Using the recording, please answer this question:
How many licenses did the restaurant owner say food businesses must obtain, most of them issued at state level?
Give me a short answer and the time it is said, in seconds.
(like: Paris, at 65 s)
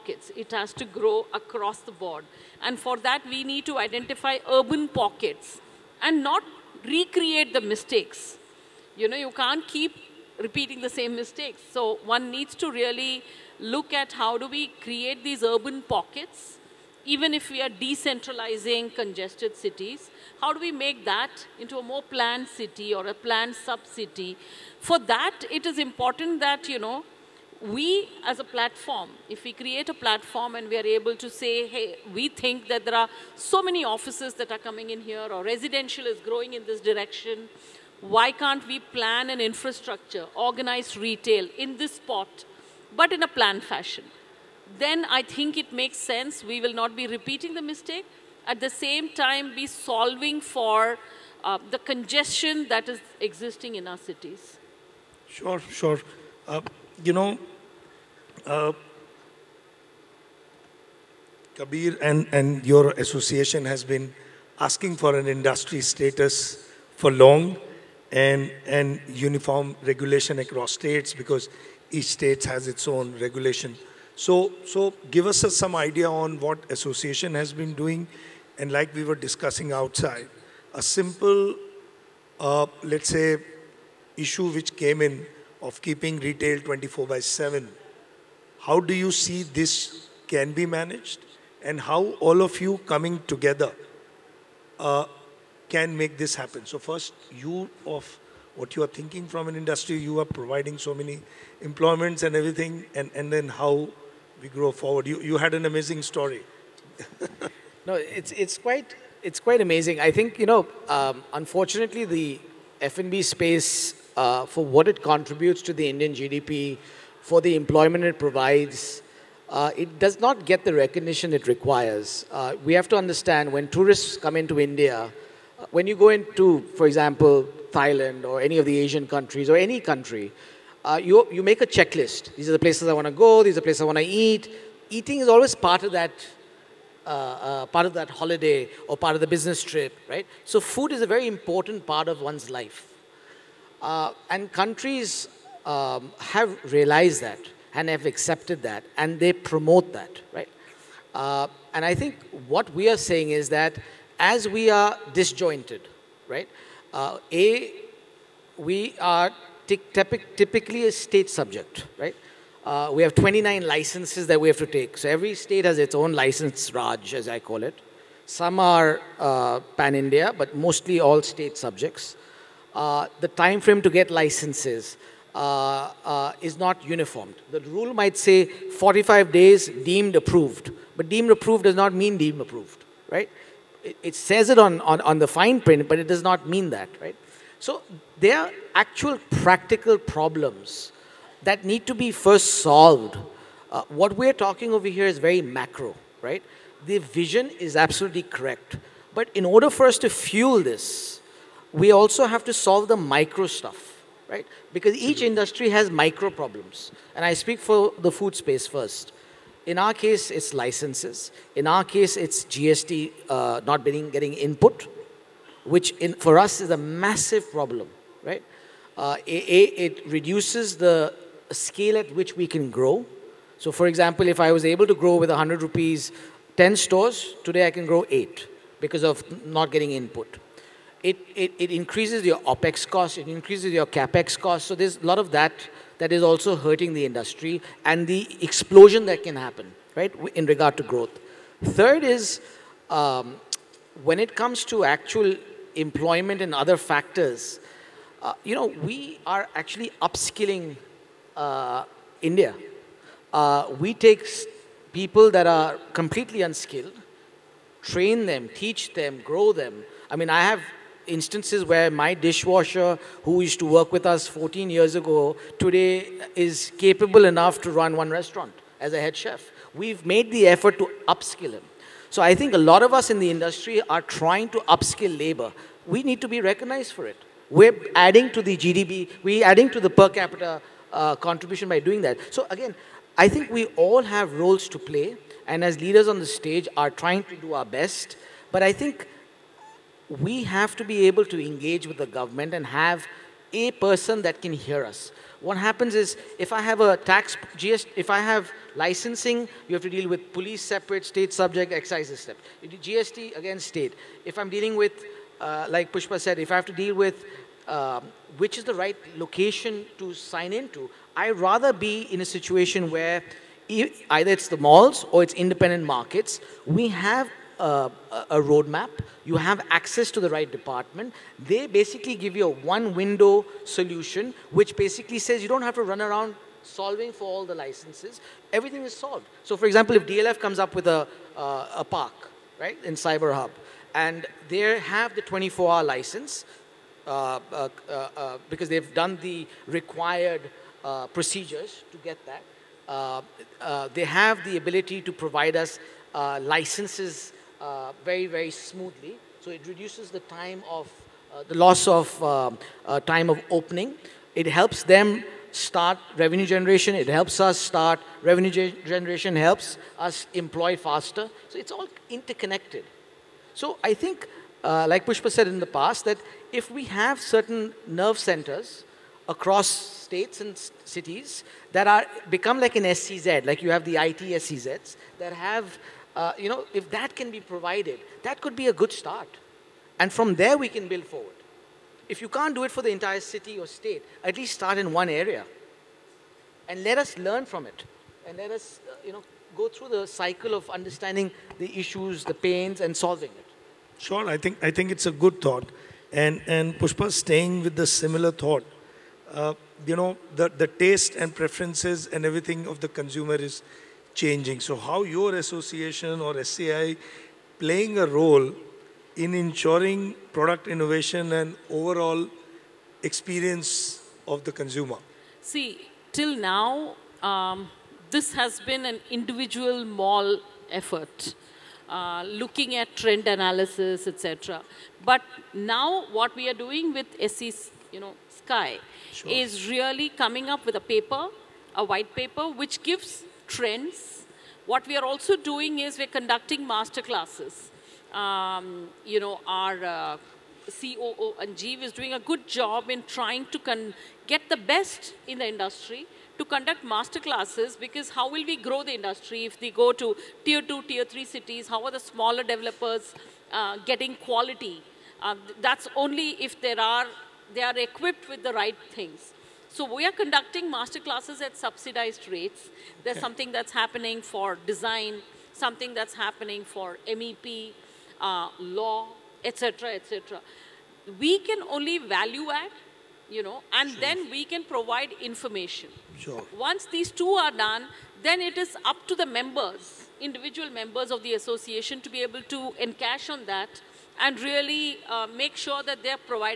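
29, at 163 s.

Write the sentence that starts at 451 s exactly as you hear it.
How are the smaller developers uh, getting quality?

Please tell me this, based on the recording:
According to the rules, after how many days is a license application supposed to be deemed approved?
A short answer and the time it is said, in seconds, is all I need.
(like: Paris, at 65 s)
45 days, at 178 s.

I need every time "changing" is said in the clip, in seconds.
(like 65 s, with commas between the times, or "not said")
404 s.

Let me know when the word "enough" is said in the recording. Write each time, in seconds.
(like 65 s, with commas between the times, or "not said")
267 s.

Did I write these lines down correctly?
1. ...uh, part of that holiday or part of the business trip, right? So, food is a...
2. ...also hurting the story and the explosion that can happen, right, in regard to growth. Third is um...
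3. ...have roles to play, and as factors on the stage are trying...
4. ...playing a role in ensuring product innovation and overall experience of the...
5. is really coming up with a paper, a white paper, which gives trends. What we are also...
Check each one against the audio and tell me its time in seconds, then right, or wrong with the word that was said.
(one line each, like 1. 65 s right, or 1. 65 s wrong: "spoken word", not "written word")
1. 137 s right
2. 236 s wrong: "industry", not "story"
3. 284 s wrong: "leaders", not "factors"
4. 407 s right
5. 429 s right.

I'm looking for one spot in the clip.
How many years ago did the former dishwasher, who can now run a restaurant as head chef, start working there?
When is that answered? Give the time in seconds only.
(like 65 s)
264 s.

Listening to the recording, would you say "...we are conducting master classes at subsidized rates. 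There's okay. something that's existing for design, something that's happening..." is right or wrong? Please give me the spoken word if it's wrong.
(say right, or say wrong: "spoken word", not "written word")
wrong: "happening", not "existing".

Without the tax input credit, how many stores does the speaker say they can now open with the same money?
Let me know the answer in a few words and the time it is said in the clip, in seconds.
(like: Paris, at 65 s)
8, at 228 s.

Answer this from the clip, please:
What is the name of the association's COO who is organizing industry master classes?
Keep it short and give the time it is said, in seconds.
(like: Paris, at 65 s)
Anjeev, at 441 s.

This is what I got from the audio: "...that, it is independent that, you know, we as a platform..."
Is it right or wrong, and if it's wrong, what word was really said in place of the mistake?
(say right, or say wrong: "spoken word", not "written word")
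wrong: "important", not "independent".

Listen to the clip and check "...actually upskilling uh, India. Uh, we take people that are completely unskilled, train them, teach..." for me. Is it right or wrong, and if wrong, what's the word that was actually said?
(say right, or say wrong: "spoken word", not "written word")
right.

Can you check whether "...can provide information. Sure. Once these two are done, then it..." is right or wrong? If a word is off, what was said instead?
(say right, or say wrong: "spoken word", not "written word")
right.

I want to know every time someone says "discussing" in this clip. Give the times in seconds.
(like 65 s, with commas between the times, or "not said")
79 s.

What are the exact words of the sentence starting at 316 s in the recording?
We have a roadmap, you have access to the right department.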